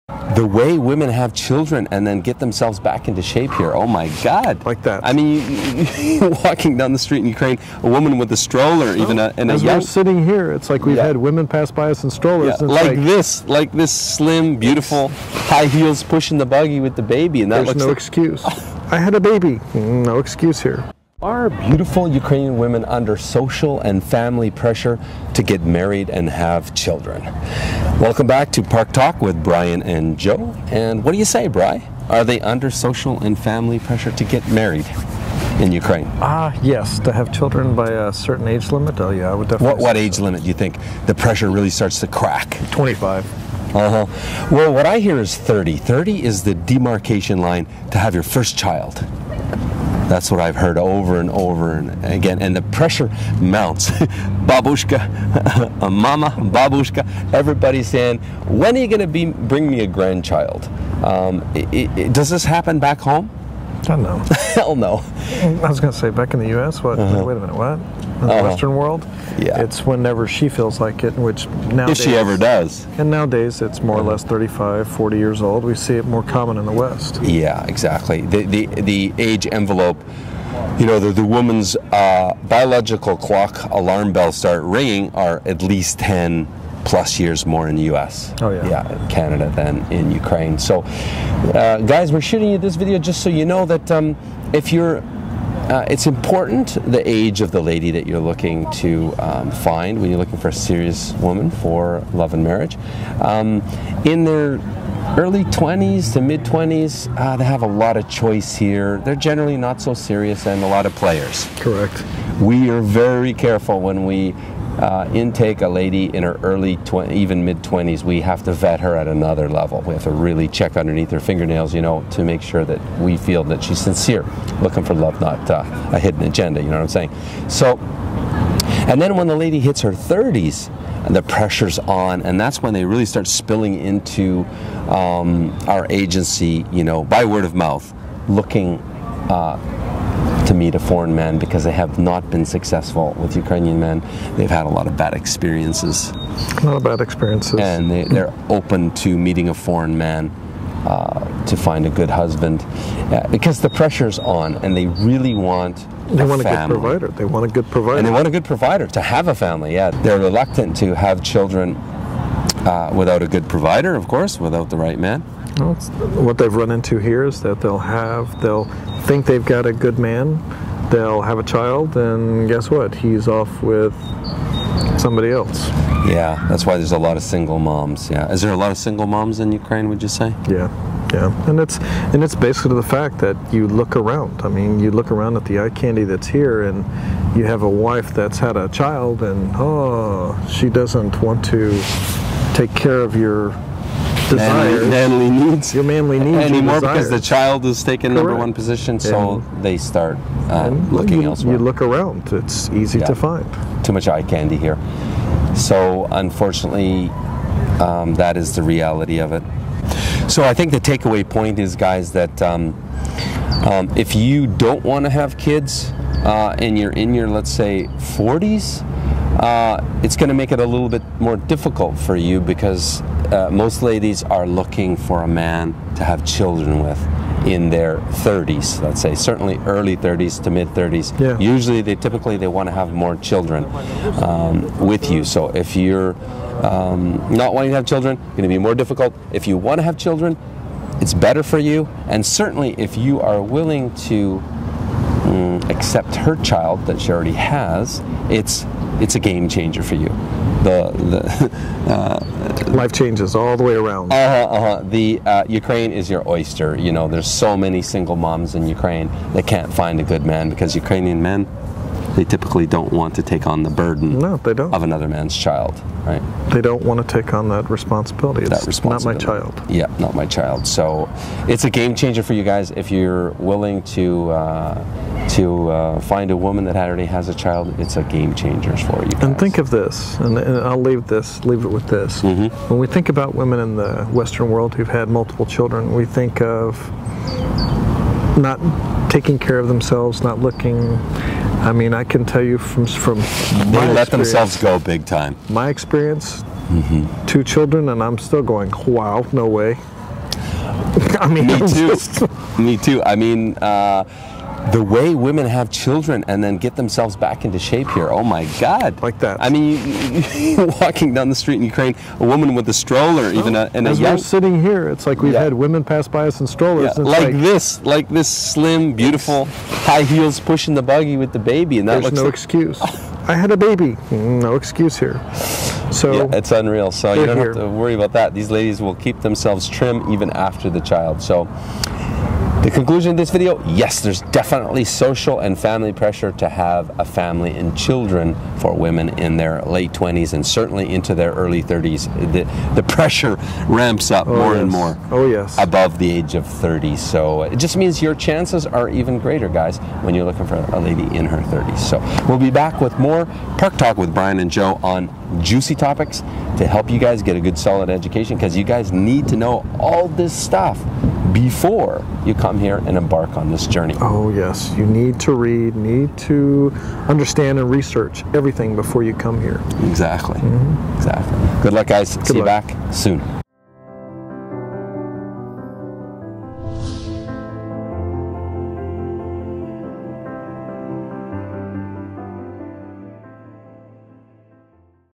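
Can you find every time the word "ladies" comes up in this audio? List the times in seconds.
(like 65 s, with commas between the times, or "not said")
223 s, 328 s.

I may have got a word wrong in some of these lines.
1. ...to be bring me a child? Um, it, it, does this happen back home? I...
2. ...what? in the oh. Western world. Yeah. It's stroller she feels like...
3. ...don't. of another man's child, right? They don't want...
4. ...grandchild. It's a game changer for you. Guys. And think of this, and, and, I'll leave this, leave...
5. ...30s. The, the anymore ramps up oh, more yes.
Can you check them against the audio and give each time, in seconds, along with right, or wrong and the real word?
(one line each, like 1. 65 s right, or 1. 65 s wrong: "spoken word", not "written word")
1. 58 s wrong: "grandchild", not "child"
2. 67 s wrong: "whenever", not "stroller"
3. 264 s right
4. 277 s wrong: "child", not "grandchild"
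5. 341 s wrong: "pressure", not "anymore".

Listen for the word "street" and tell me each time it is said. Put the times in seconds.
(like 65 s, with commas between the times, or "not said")
6 s, 311 s.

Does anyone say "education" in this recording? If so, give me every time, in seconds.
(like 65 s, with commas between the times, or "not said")
357 s.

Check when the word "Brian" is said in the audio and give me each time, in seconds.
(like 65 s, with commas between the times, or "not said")
29 s, 354 s.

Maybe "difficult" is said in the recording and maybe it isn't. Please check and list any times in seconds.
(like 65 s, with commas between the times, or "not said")
221 s, 238 s.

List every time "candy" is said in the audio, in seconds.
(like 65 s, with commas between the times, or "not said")
185 s, 204 s.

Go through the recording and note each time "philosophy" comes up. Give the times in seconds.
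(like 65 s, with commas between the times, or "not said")
not said.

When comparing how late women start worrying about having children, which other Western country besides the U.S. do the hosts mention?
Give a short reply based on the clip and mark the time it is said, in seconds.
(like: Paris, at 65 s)
Canada, at 89 s.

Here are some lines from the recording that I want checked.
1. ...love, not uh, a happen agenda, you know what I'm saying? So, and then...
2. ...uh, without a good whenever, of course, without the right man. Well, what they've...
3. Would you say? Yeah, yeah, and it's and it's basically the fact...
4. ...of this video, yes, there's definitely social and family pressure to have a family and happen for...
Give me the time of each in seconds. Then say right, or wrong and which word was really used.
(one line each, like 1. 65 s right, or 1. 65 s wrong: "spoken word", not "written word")
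1. 124 s wrong: "hidden", not "happen"
2. 162 s wrong: "provider", not "whenever"
3. 179 s right
4. 333 s wrong: "children", not "happen".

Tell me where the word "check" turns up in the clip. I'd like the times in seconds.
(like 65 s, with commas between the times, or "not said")
120 s.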